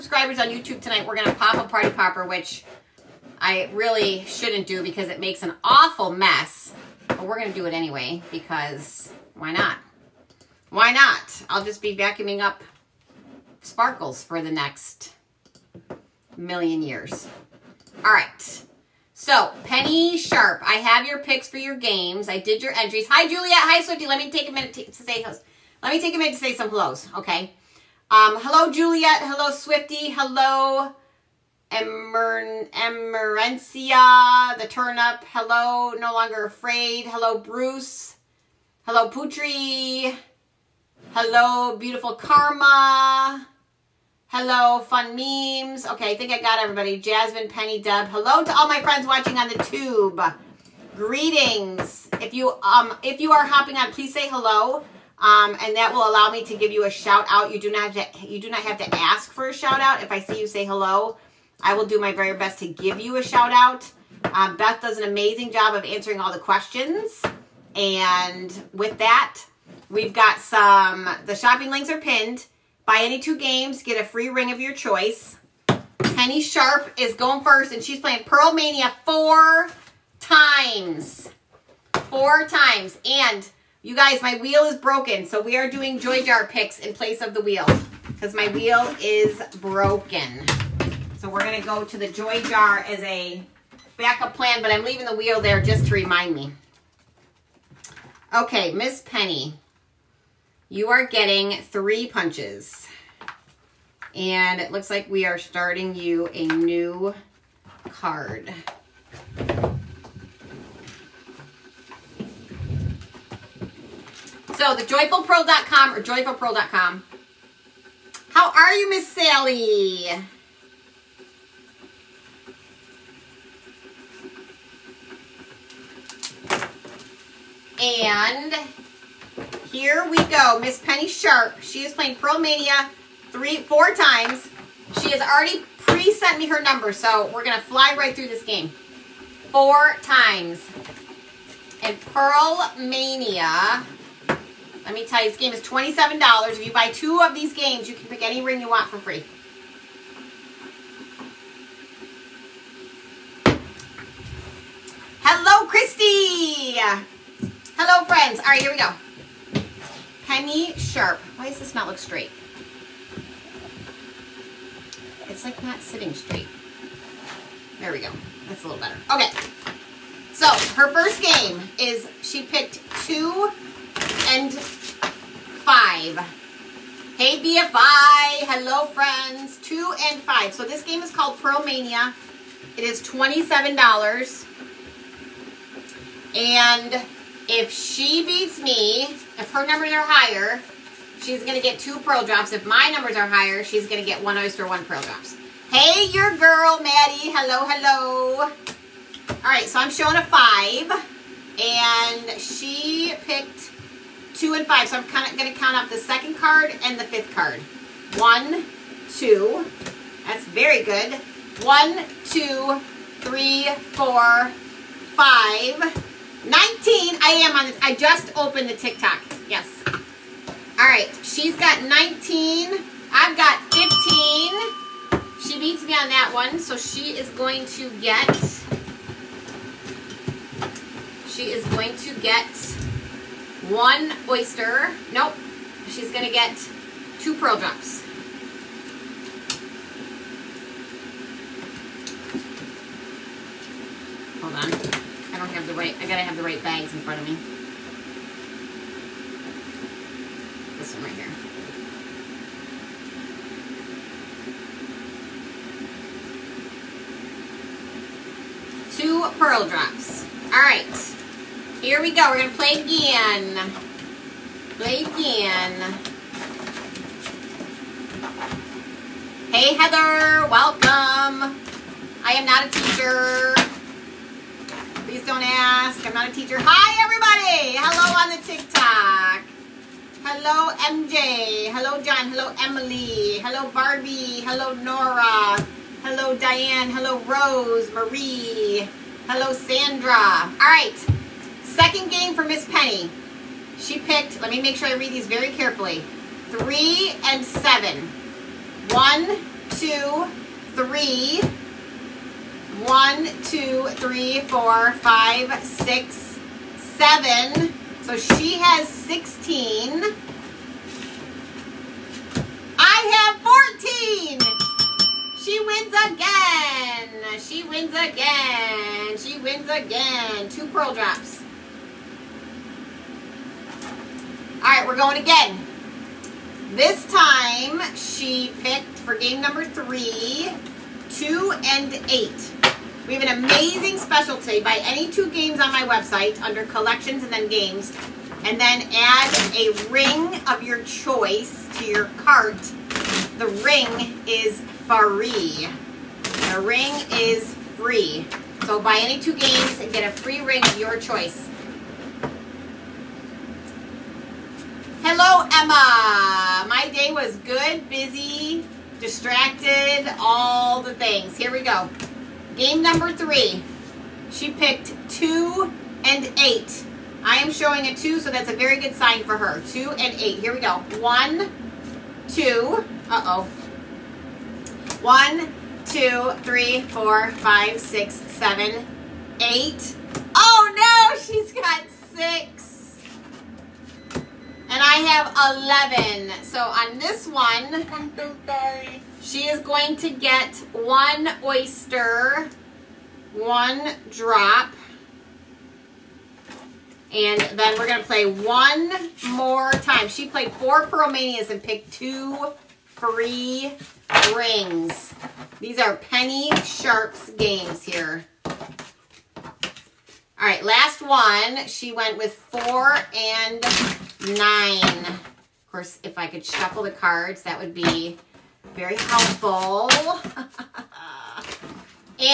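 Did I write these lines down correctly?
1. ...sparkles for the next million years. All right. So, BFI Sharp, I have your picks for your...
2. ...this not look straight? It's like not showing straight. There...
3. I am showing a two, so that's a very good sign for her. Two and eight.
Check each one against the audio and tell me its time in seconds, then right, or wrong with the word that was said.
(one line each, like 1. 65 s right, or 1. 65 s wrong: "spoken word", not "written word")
1. 13 s wrong: "Penny", not "BFI"
2. 161 s wrong: "sitting", not "showing"
3. 367 s right.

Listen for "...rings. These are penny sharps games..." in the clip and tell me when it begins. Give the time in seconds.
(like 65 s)
404 s.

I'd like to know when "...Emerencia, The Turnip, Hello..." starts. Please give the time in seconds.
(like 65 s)
32 s.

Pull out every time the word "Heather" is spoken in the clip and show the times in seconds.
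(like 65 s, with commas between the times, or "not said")
269 s.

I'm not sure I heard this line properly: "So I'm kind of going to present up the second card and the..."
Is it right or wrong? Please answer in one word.
wrong.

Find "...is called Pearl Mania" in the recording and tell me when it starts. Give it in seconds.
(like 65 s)
181 s.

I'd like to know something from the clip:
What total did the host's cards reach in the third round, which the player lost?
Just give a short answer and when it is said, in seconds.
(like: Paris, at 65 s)
11, at 386 s.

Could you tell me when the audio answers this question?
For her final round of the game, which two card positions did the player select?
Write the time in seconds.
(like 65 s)
412 s.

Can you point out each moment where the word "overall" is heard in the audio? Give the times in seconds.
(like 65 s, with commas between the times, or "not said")
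not said.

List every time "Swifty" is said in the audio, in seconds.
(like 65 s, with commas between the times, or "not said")
23 s, 29 s.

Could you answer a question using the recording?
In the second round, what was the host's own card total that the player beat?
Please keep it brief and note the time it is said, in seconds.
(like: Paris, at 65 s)
14, at 314 s.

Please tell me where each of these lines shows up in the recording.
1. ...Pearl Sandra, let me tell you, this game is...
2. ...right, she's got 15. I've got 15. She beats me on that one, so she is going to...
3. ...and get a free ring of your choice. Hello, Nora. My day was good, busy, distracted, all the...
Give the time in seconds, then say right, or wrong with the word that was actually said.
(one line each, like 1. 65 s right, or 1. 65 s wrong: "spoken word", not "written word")
1. 142 s wrong: "Mania", not "Sandra"
2. 220 s wrong: "19", not "15"
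3. 349 s wrong: "Emma", not "Nora".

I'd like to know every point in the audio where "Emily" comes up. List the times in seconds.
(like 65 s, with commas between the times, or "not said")
282 s.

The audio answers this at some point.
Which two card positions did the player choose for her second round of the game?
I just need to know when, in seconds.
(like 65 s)
296 s.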